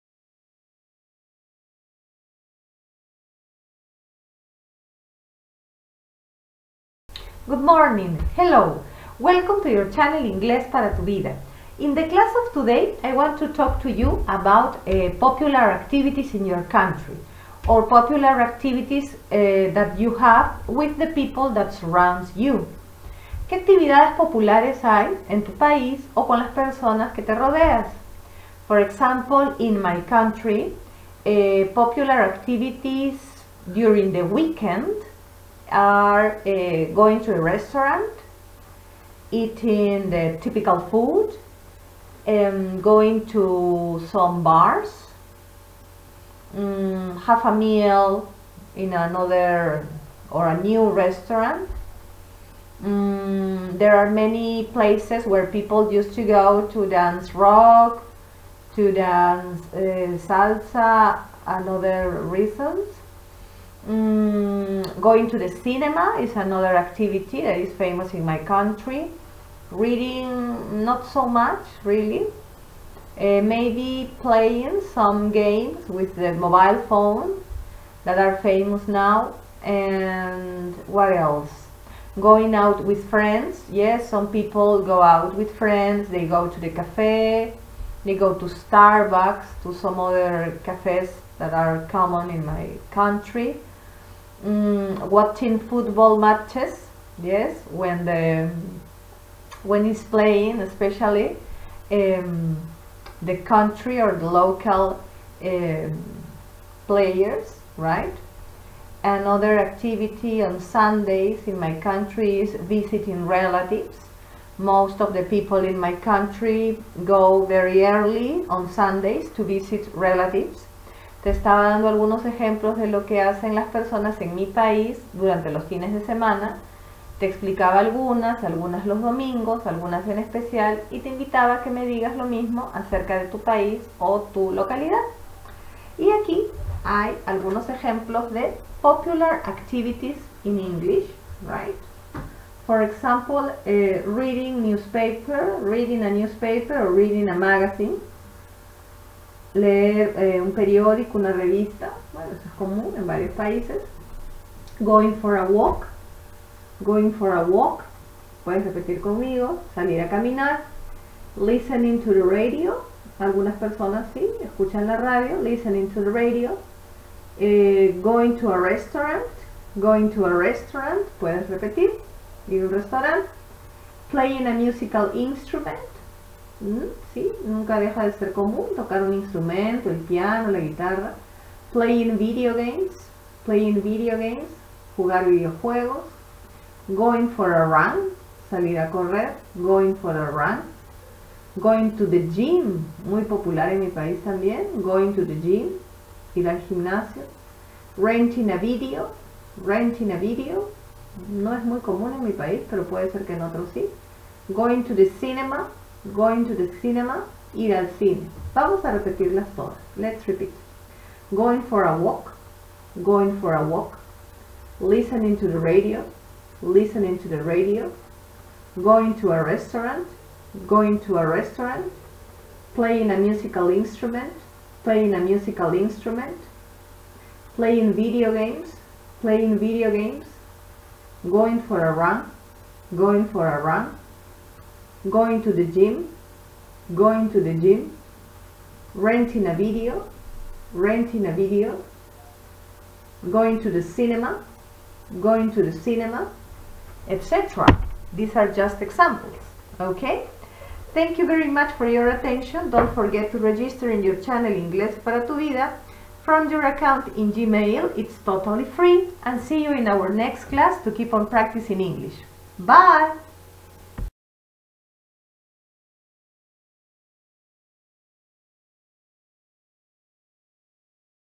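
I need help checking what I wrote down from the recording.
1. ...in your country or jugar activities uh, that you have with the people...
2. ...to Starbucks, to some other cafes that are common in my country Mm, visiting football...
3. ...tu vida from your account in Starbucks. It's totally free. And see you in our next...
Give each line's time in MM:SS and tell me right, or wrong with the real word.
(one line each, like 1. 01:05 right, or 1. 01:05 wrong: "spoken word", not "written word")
1. 00:16 wrong: "popular", not "jugar"
2. 01:28 wrong: "watching", not "visiting"
3. 04:15 wrong: "Gmail", not "Starbucks".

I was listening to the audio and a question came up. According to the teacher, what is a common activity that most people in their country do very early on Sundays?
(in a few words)
visiting relatives.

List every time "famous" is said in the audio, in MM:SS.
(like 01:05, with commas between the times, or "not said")
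01:07, 01:18.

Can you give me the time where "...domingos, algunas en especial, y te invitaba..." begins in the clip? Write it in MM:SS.
02:09.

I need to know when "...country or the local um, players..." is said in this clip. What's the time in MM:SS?
01:43.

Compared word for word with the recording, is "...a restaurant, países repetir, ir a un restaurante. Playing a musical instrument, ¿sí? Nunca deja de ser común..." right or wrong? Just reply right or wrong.
wrong.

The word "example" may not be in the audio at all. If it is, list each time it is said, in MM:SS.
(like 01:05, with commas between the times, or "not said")
00:28, 02:22, 04:08.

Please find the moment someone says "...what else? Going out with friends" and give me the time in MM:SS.
01:20.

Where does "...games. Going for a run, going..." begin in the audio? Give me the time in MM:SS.
03:49.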